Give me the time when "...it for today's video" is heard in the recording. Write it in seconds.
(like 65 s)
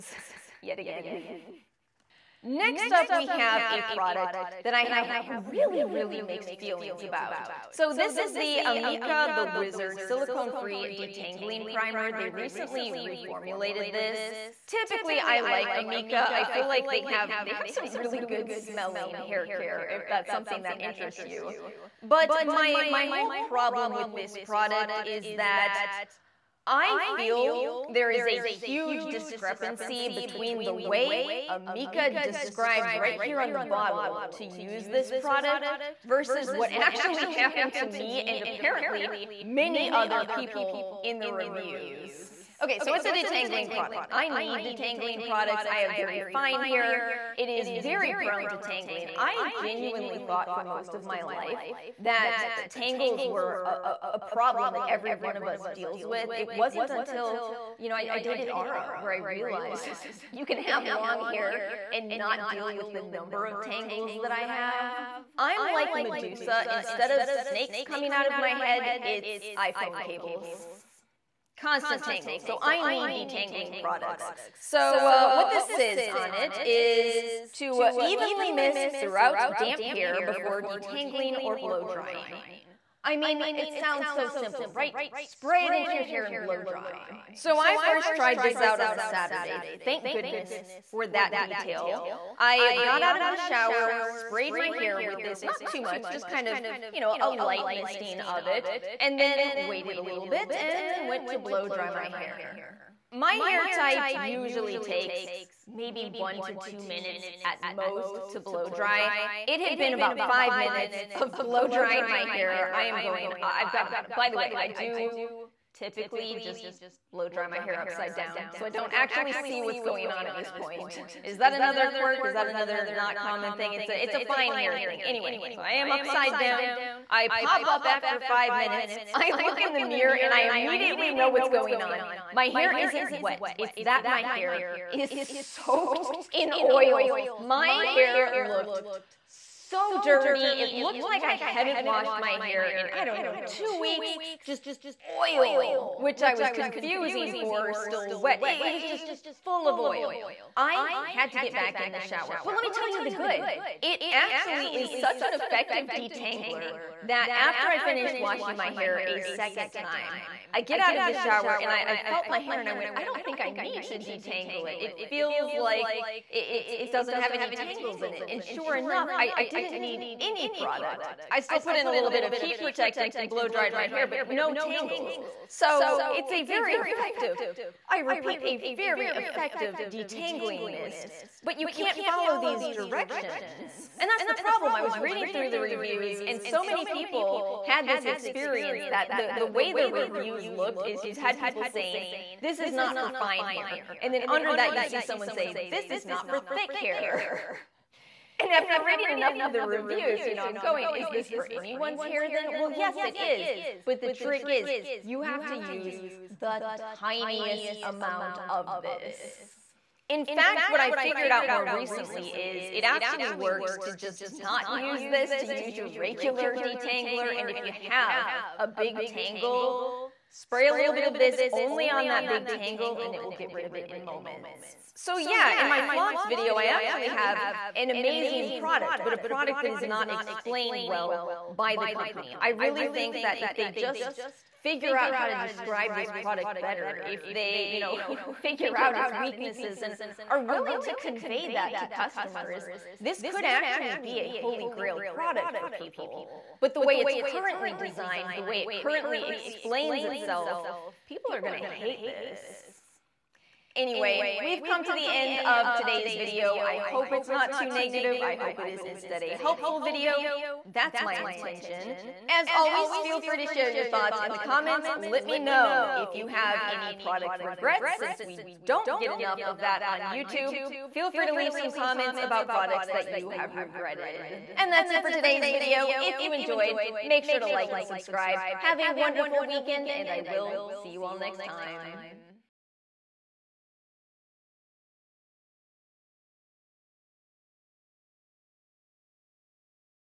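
274 s.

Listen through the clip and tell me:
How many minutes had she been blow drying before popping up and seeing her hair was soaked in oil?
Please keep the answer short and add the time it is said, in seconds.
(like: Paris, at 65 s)
5, at 128 s.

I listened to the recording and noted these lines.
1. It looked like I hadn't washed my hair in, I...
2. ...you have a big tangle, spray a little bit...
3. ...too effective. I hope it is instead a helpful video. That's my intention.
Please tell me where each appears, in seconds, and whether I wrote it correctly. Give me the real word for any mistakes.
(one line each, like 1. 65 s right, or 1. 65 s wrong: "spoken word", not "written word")
1. 140 s right
2. 217 s right
3. 257 s wrong: "negative", not "effective".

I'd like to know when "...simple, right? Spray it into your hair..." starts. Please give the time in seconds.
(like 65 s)
84 s.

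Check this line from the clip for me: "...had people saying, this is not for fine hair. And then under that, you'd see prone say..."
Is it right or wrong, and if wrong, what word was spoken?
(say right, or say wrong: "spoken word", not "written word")
wrong: "someone", not "prone".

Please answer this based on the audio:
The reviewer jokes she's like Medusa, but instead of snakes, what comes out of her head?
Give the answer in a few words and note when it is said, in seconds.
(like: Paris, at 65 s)
iPhone cables, at 69 s.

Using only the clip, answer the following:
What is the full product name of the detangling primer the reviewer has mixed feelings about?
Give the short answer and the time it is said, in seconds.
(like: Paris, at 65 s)
The Wizard, at 9 s.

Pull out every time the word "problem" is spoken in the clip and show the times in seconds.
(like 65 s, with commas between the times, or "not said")
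23 s, 54 s, 184 s.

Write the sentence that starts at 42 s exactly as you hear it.
Okay, so it's a detangling product.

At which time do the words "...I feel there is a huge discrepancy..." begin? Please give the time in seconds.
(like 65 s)
26 s.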